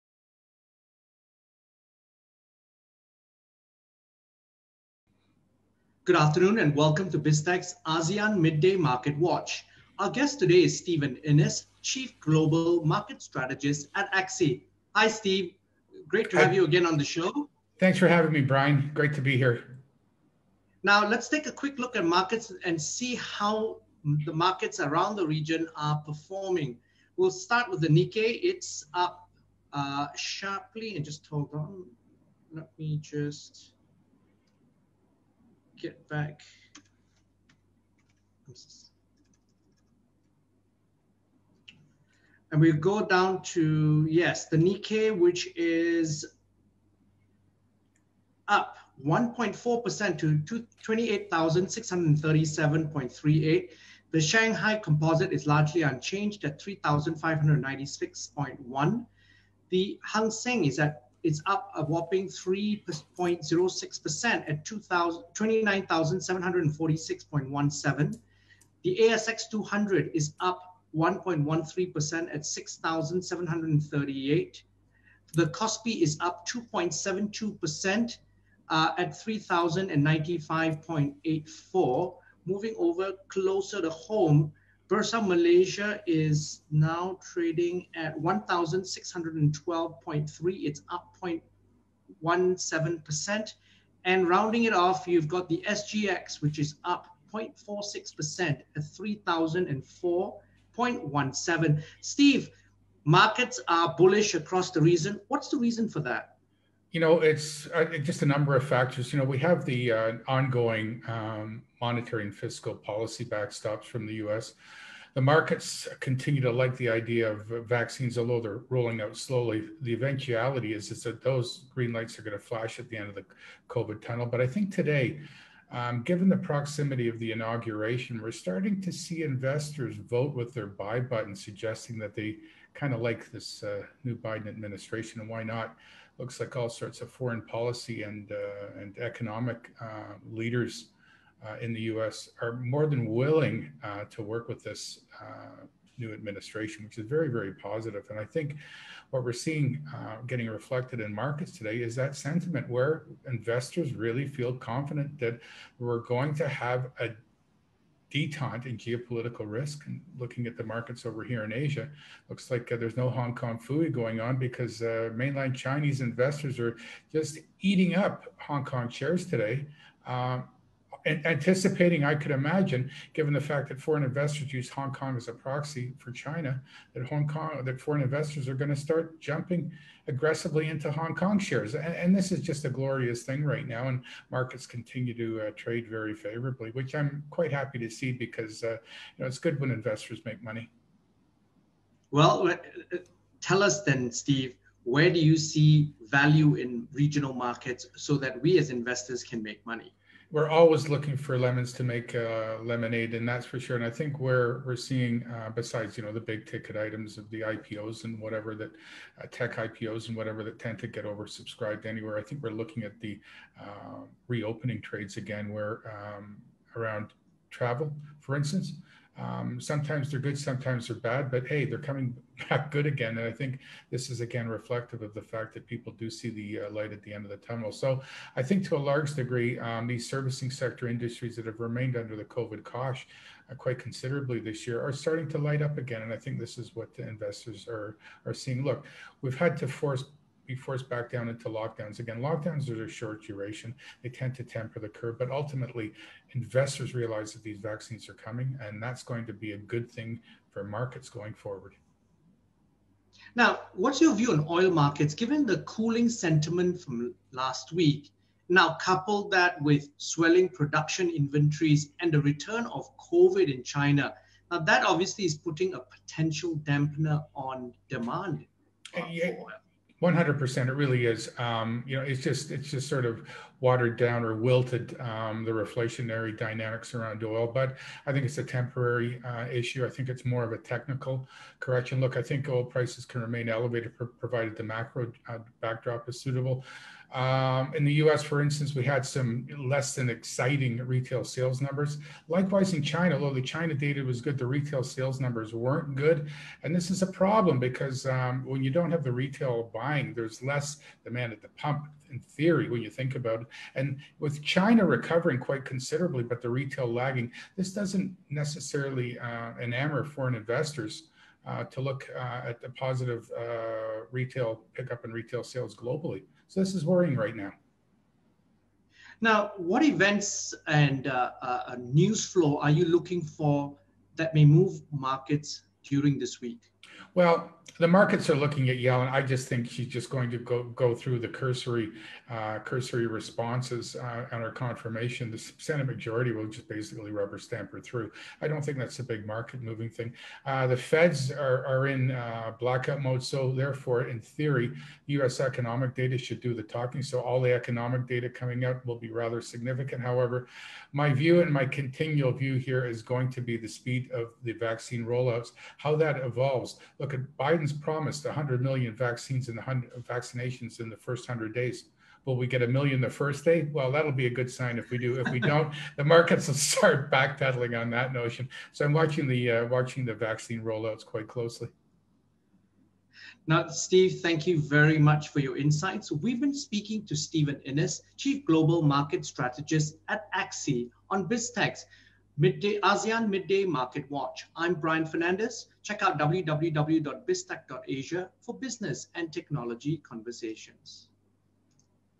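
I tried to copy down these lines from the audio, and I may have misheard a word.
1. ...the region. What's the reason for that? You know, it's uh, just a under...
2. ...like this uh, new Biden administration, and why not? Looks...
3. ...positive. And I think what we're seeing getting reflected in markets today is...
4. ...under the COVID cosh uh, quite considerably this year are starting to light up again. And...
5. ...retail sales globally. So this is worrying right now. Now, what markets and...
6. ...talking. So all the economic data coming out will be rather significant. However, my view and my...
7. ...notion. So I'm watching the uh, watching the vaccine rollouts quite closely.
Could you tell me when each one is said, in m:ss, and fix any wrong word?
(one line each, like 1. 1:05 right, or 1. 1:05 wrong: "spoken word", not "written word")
1. 1:44 wrong: "number", not "under"
2. 2:13 right
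3. 2:27 right
4. 3:51 right
5. 5:15 wrong: "events", not "markets"
6. 5:46 right
7. 6:08 right.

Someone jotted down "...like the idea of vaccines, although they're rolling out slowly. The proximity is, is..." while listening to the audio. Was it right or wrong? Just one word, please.
wrong.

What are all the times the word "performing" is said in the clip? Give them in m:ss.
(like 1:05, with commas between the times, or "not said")
0:25.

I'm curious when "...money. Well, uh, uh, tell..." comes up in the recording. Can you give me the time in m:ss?
3:10.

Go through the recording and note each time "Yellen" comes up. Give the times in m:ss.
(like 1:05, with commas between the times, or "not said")
5:28.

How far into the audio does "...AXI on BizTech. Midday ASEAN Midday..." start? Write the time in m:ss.
6:20.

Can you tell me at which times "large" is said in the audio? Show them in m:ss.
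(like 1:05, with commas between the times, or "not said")
3:48.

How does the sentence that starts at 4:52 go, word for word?
Likewise, in China, although the China data was good, the retail sales numbers weren't good.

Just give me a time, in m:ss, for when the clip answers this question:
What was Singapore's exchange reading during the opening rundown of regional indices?
1:38.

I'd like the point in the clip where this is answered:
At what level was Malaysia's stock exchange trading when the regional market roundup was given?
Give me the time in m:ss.
1:28.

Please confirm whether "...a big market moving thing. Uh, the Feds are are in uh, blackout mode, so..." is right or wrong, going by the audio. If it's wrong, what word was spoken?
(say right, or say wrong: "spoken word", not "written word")
right.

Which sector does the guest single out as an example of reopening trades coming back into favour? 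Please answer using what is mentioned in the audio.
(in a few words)
travel.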